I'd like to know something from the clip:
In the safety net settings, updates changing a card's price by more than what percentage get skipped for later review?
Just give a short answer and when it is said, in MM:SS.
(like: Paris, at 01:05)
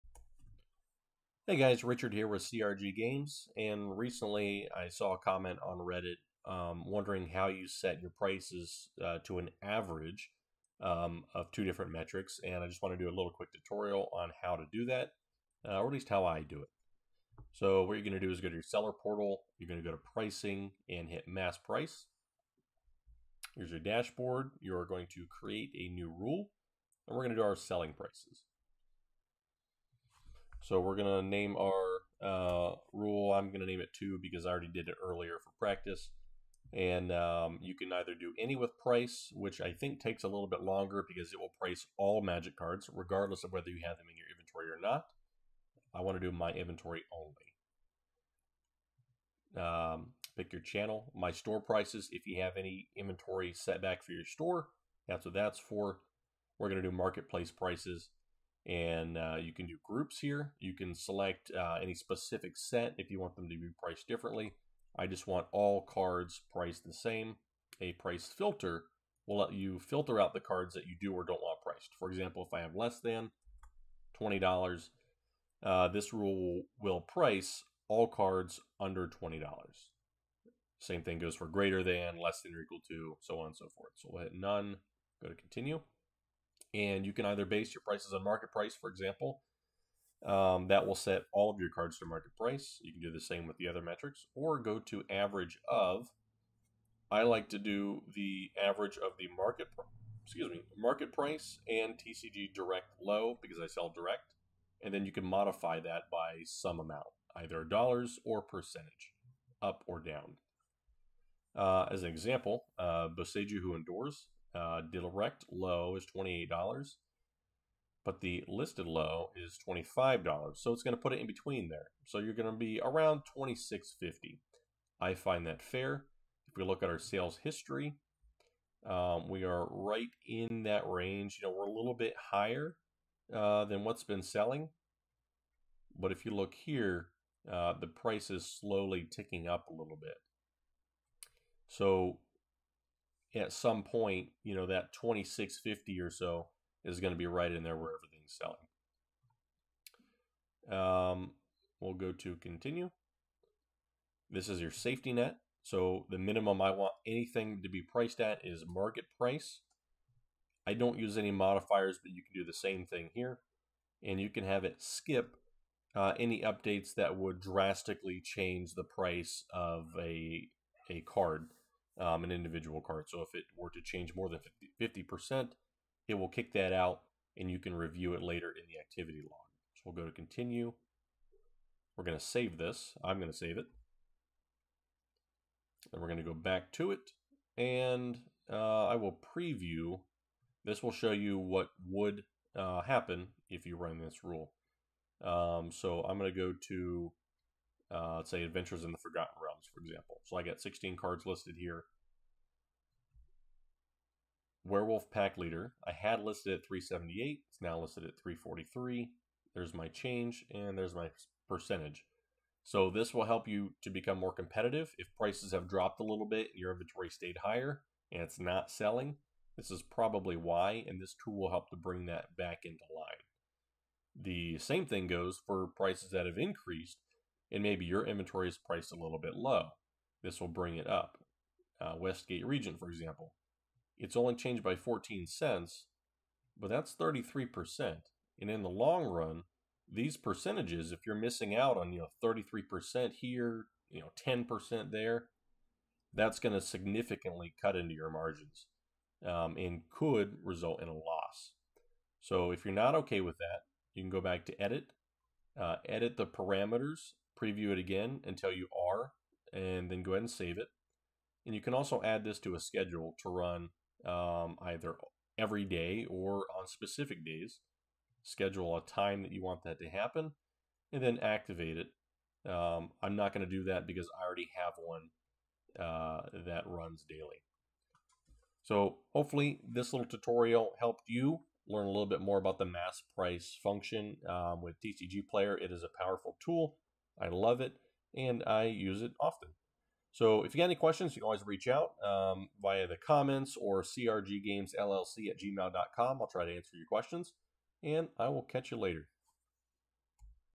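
50 percent, at 02:54.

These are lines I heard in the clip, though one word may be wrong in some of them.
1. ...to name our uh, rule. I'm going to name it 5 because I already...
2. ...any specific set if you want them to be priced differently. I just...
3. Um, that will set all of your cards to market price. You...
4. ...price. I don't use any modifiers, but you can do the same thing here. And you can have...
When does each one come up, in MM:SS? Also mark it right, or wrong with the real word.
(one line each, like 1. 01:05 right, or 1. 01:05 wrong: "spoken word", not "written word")
1. 00:31 wrong: "2", not "5"
2. 01:01 right
3. 01:30 right
4. 02:39 right.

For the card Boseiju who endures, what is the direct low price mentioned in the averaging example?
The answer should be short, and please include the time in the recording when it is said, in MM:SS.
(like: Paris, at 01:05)
$28, at 01:56.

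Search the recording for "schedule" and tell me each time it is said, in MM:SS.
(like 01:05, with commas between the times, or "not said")
04:22, 04:28.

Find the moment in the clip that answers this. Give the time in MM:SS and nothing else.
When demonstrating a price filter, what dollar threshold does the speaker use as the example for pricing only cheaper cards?
01:12.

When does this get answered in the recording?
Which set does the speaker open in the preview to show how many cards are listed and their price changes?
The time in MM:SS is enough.
03:18.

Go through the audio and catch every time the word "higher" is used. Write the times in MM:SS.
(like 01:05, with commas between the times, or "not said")
02:12, 03:37.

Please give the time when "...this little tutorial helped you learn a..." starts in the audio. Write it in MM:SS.
04:39.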